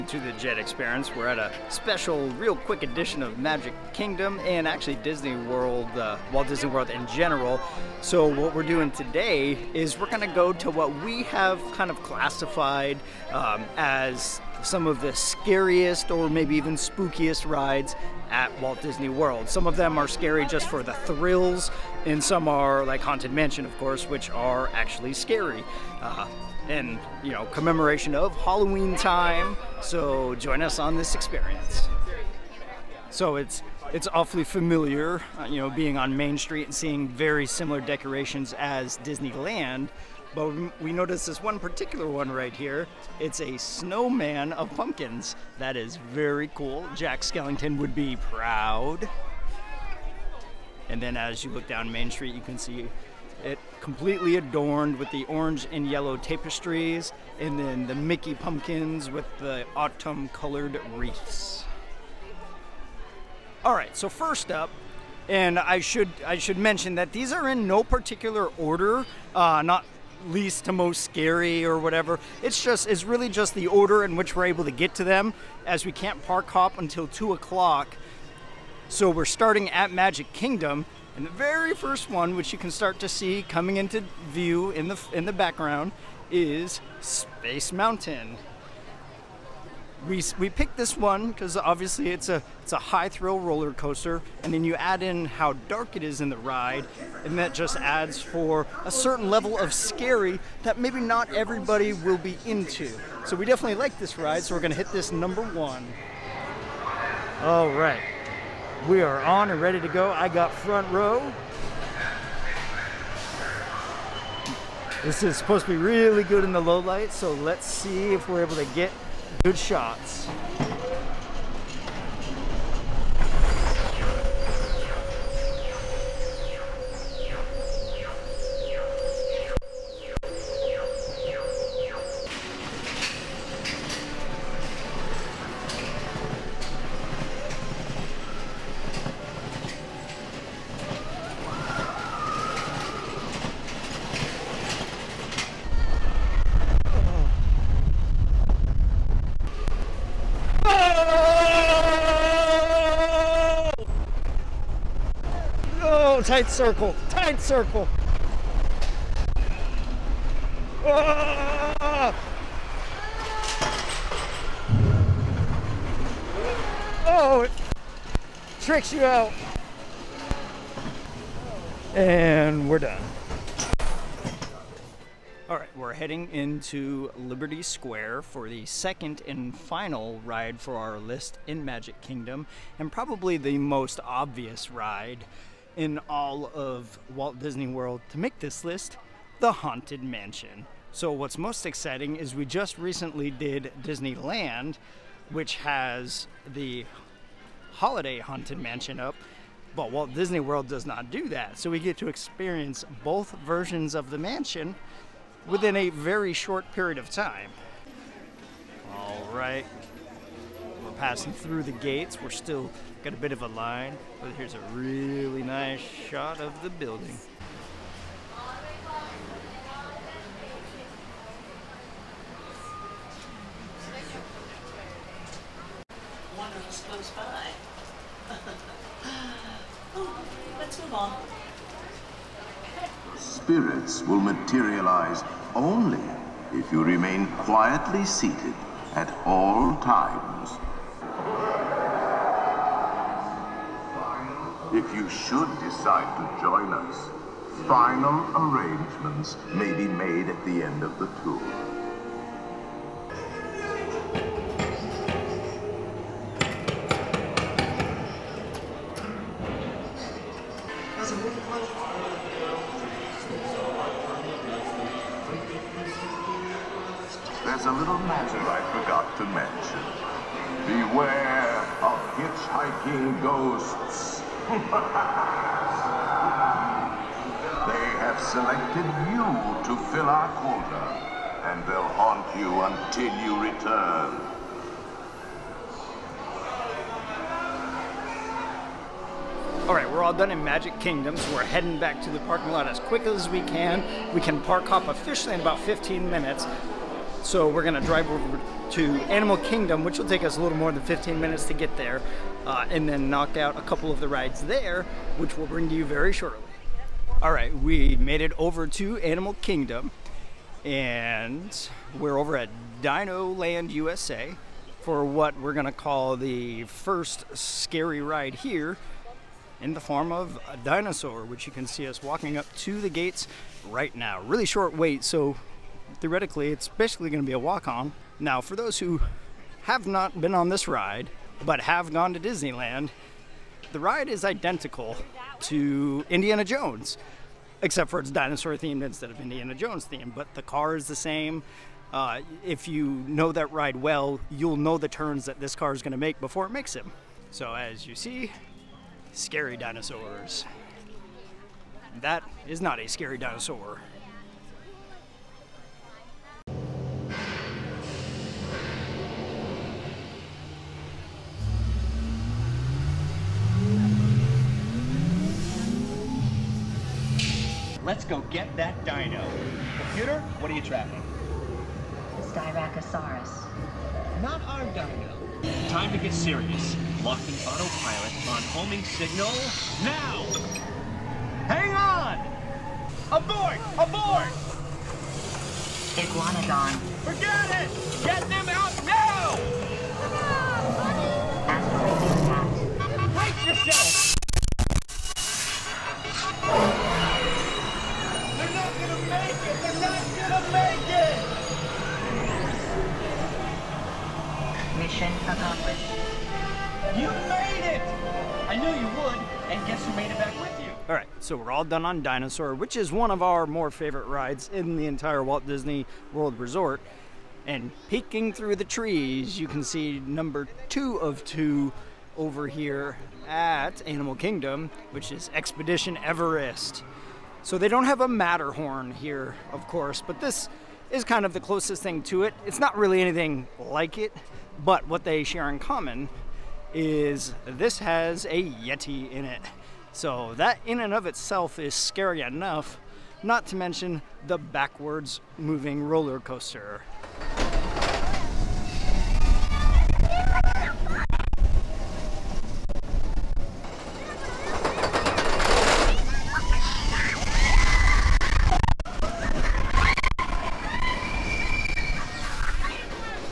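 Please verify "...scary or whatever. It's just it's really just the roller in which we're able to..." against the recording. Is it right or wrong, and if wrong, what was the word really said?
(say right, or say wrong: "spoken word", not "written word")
wrong: "order", not "roller".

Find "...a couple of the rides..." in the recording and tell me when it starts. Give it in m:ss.
5:03.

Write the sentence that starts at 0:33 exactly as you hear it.
So it's it's awfully familiar, uh, you know, being on Main Street and seeing very similar decorations as Disneyland.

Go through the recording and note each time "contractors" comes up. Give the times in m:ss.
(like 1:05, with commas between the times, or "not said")
not said.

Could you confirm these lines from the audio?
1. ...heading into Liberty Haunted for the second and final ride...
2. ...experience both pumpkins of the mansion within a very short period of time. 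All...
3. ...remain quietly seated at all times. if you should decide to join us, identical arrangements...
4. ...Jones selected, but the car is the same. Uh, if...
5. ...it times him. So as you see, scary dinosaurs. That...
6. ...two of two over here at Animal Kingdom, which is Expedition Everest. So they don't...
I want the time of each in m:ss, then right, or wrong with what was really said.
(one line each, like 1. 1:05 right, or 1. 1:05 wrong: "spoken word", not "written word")
1. 2:55 wrong: "Square", not "Haunted"
2. 3:22 wrong: "versions", not "pumpkins"
3. 3:56 wrong: "final", not "identical"
4. 5:39 wrong: "themed", not "selected"
5. 5:46 wrong: "makes", not "times"
6. 7:00 right.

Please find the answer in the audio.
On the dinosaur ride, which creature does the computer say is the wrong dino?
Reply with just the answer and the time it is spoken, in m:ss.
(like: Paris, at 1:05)
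Styracosaurus, at 6:12.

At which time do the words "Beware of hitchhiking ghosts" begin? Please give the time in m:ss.
4:30.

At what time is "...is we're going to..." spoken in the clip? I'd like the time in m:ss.
0:09.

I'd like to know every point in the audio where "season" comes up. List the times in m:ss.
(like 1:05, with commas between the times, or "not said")
not said.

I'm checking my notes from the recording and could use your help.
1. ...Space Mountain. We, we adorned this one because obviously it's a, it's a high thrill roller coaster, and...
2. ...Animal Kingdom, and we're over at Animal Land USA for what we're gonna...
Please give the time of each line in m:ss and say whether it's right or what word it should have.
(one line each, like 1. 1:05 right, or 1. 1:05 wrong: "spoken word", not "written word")
1. 1:27 wrong: "picked", not "adorned"
2. 5:08 wrong: "Dino", not "Animal".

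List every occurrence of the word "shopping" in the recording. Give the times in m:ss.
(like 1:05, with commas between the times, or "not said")
not said.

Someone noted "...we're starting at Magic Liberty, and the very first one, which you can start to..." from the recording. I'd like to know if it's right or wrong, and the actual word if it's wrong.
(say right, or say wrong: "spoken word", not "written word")
wrong: "Kingdom", not "Liberty".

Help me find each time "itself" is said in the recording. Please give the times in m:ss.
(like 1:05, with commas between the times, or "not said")
7:21.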